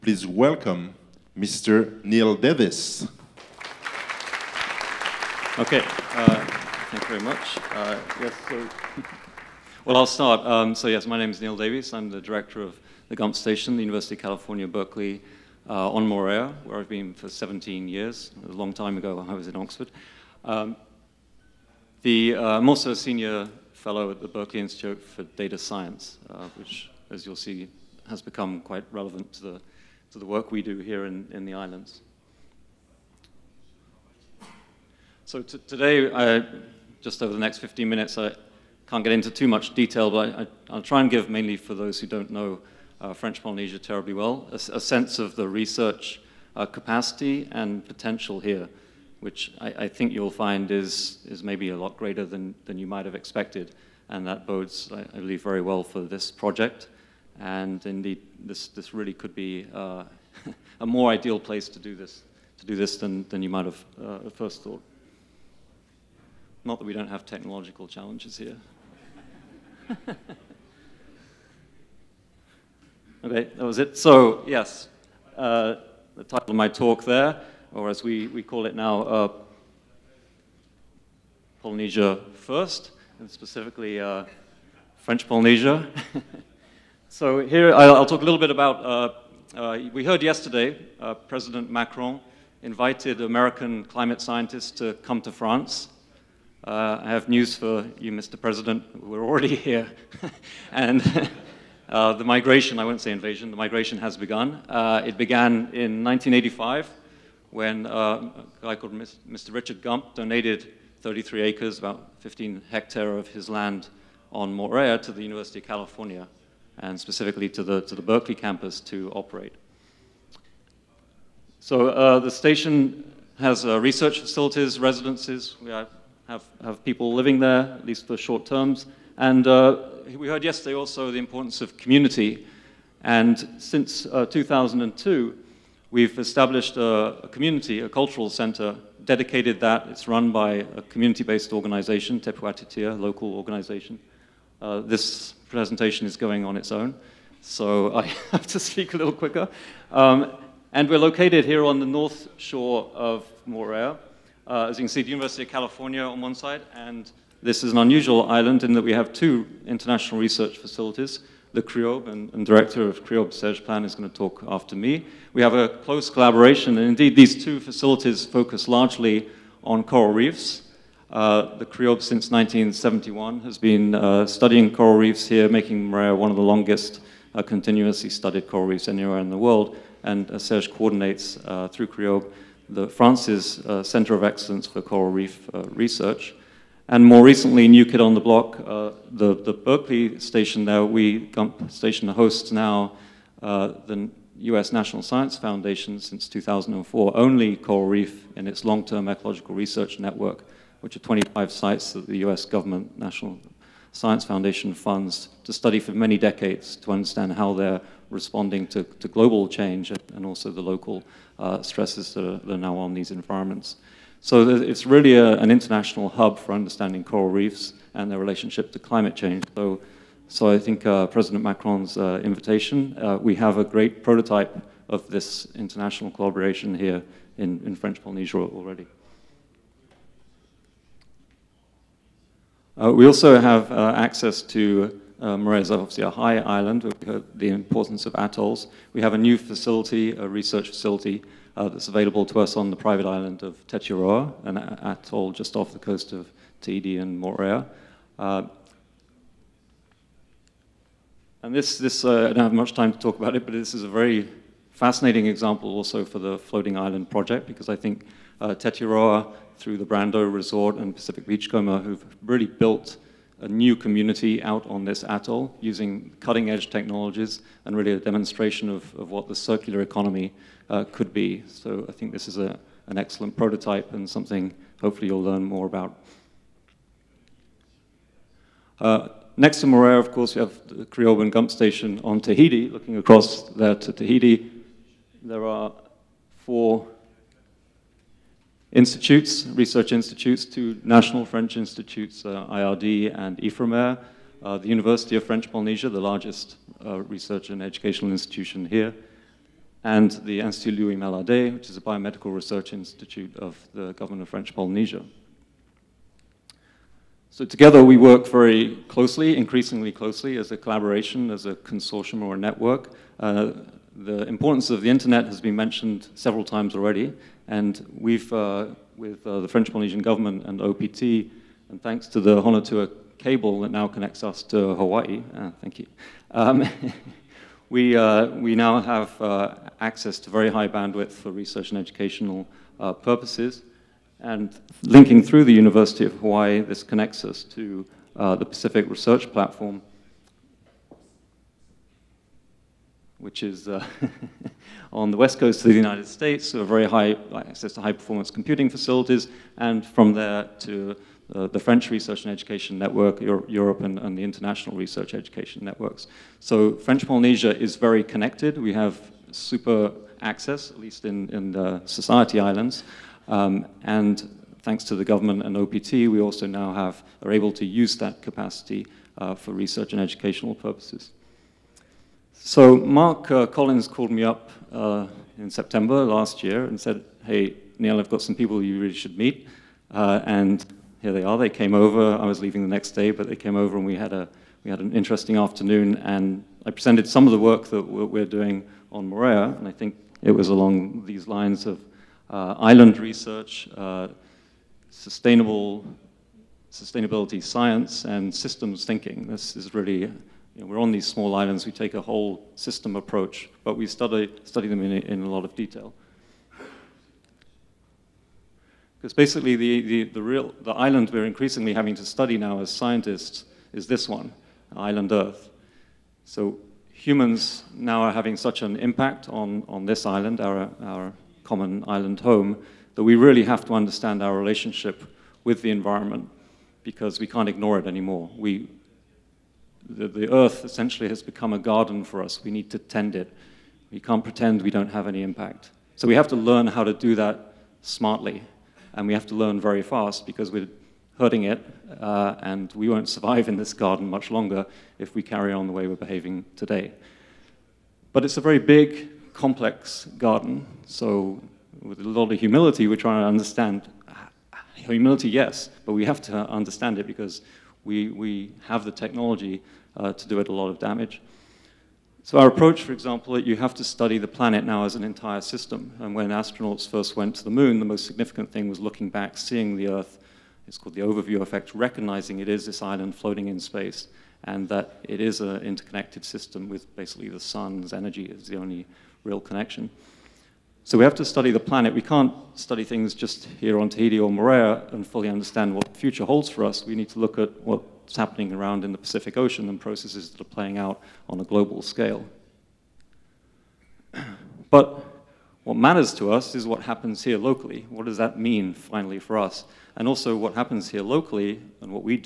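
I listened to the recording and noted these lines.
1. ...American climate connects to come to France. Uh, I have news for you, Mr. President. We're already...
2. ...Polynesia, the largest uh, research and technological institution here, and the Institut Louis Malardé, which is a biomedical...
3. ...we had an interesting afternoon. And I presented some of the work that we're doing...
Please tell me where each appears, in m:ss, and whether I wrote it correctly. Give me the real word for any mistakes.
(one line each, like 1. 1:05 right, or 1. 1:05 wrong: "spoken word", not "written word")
1. 1:33 wrong: "scientists", not "connects"
2. 4:55 wrong: "educational", not "technological"
3. 6:24 right.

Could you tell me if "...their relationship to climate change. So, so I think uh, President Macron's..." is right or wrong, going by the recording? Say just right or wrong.
right.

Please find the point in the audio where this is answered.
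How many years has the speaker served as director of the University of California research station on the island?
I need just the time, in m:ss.
0:17.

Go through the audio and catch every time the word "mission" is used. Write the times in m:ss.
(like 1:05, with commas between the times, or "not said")
not said.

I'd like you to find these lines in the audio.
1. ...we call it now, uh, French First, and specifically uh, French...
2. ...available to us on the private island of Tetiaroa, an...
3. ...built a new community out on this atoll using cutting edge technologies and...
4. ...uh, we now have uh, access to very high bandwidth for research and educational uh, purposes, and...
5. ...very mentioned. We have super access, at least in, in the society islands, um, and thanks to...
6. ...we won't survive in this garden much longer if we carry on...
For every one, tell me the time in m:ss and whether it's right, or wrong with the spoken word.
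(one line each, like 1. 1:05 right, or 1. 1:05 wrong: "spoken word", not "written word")
1. 1:18 wrong: "Polynesia", not "French"
2. 4:01 right
3. 4:22 right
4. 5:27 right
5. 5:57 wrong: "connected", not "mentioned"
6. 7:22 right.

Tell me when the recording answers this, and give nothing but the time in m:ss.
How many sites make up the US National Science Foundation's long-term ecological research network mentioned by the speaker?
3:21.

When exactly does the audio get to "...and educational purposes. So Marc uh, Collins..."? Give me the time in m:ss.
6:09.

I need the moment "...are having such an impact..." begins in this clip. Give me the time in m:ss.
6:58.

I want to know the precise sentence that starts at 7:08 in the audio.
We, the, the earth essentially has become a garden for us.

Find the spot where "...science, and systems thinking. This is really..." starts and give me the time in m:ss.
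6:37.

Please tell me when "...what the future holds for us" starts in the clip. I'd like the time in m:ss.
8:05.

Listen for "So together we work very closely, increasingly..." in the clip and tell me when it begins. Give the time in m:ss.
5:07.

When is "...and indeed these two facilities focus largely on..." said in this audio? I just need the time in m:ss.
2:46.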